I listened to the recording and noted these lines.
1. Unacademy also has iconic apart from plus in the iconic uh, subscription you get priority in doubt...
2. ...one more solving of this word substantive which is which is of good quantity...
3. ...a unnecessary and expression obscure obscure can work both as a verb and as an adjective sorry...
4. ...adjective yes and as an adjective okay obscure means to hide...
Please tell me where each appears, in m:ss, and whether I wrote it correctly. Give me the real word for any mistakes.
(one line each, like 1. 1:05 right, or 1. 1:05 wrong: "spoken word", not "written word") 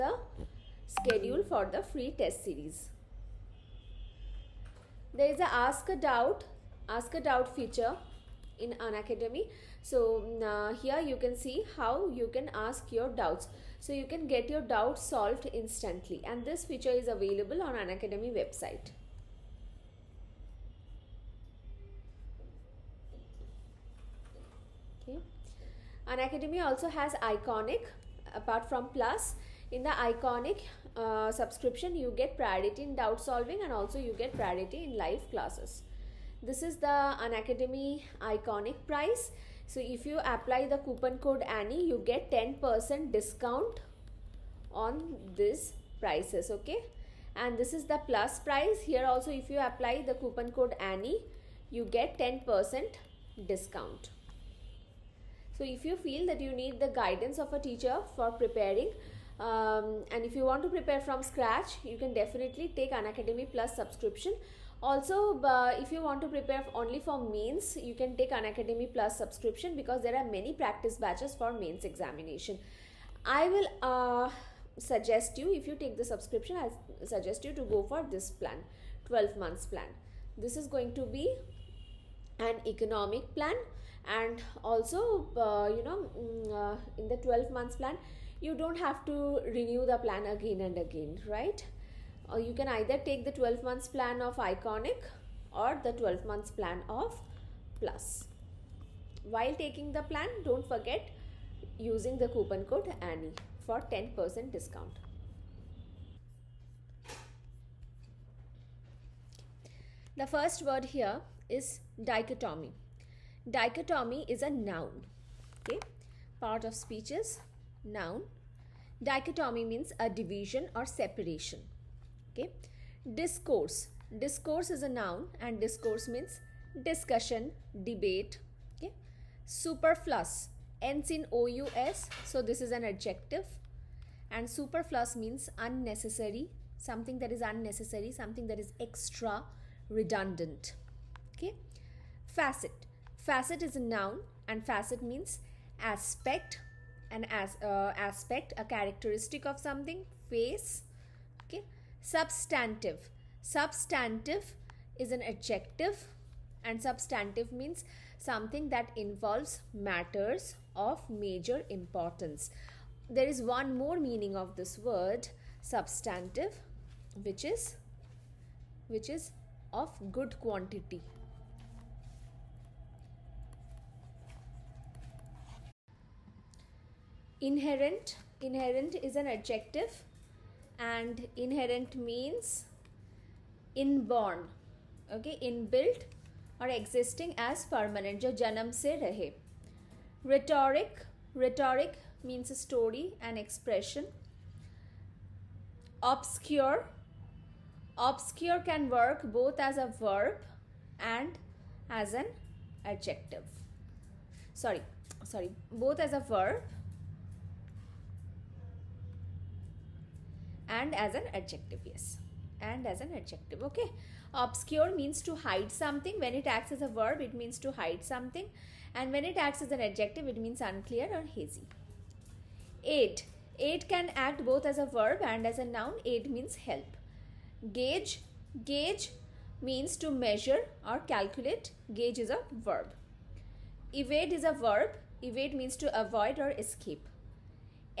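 1. 0:26 right
2. 2:43 wrong: "meaning", not "solving"
3. 3:12 wrong: "story", not "unnecessary"
4. 3:31 right.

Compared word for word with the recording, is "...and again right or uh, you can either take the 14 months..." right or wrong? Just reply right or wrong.
wrong.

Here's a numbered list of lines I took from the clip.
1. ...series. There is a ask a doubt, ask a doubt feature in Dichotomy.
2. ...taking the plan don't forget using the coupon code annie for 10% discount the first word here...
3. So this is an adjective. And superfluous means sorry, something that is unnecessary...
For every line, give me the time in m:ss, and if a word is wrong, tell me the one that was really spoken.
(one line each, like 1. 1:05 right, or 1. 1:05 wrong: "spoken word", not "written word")
1. 0:02 wrong: "Unacademy", not "Dichotomy"
2. 1:39 right
3. 2:12 wrong: "unnecessary", not "sorry".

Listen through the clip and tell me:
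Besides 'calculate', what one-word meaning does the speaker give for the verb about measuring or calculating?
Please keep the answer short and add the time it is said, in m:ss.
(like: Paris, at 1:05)
Measure, at 3:50.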